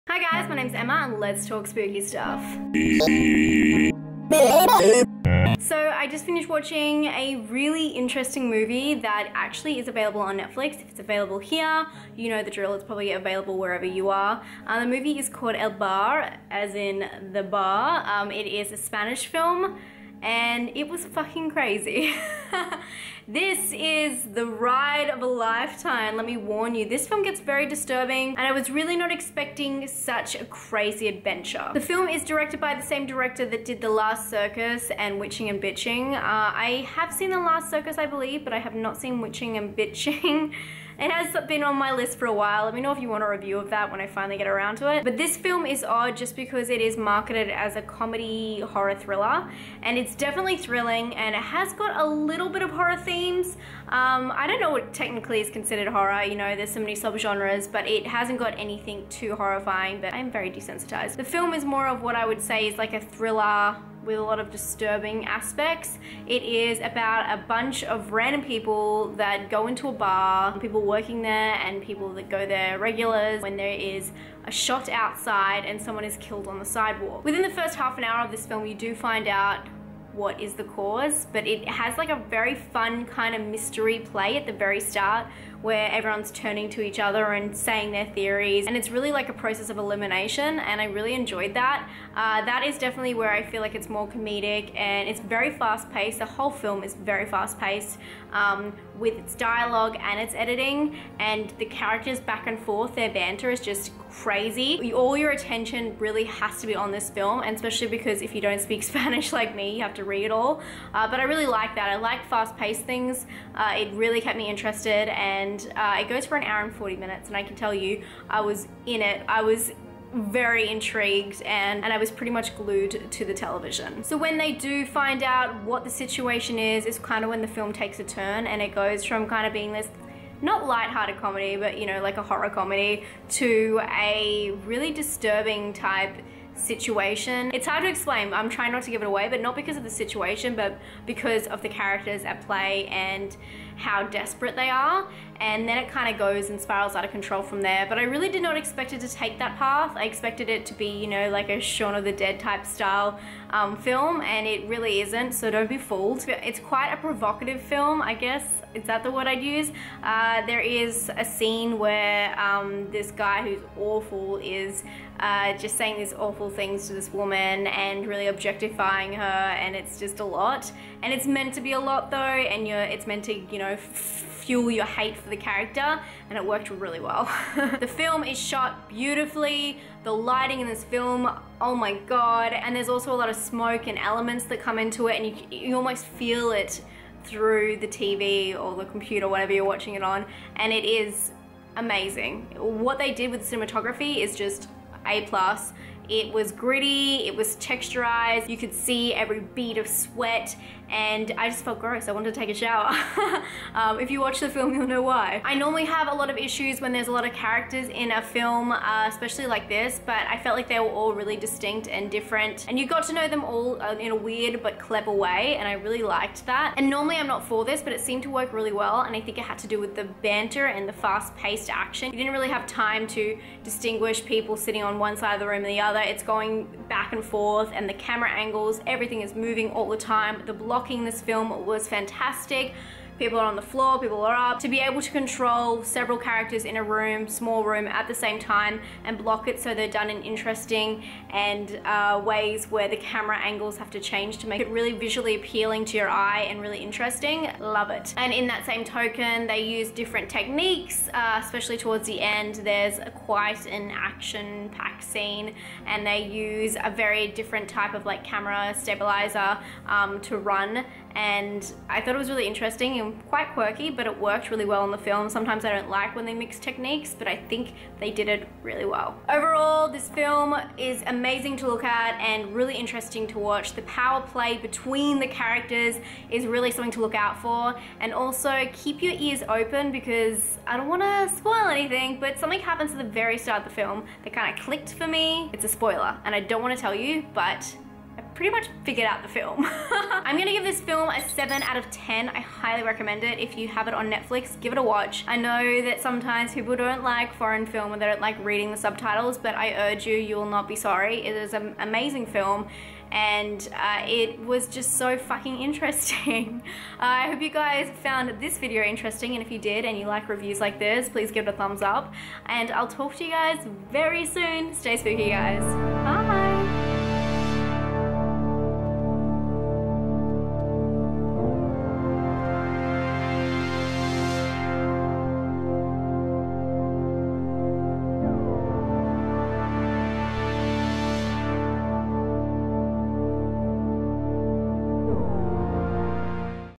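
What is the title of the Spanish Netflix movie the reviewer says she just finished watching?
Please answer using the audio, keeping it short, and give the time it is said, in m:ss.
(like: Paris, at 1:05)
El Bar, at 0:15.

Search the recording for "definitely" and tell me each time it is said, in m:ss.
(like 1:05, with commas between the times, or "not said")
0:50, 1:32.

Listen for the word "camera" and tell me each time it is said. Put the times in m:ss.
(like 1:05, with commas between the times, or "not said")
3:47, 4:02, 4:18.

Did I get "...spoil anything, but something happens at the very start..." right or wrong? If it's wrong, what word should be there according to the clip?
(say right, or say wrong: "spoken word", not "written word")
right.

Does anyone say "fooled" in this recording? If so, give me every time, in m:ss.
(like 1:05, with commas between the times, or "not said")
2:35.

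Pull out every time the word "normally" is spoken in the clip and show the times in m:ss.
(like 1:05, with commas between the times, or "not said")
3:25, 3:36.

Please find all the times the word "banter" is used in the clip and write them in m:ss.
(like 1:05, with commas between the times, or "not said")
1:43, 3:40.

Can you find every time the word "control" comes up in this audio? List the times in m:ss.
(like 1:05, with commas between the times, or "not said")
2:27, 3:55.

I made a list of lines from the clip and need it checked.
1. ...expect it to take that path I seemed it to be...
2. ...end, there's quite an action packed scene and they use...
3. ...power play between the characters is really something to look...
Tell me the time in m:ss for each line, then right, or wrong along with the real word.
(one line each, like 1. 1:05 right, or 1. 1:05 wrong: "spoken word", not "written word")
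1. 2:28 wrong: "expected", not "seemed"
2. 4:12 right
3. 4:33 right.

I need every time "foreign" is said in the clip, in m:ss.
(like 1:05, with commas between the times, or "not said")
4:57.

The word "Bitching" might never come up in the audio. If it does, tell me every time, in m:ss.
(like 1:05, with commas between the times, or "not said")
0:35, 0:39.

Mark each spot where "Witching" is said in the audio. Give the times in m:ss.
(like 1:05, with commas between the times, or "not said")
0:35, 0:39.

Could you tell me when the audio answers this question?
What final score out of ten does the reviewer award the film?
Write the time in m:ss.
4:51.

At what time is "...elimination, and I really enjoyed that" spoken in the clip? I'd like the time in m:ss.
1:29.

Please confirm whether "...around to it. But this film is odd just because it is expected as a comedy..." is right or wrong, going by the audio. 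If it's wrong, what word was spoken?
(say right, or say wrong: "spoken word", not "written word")
wrong: "marketed", not "expected".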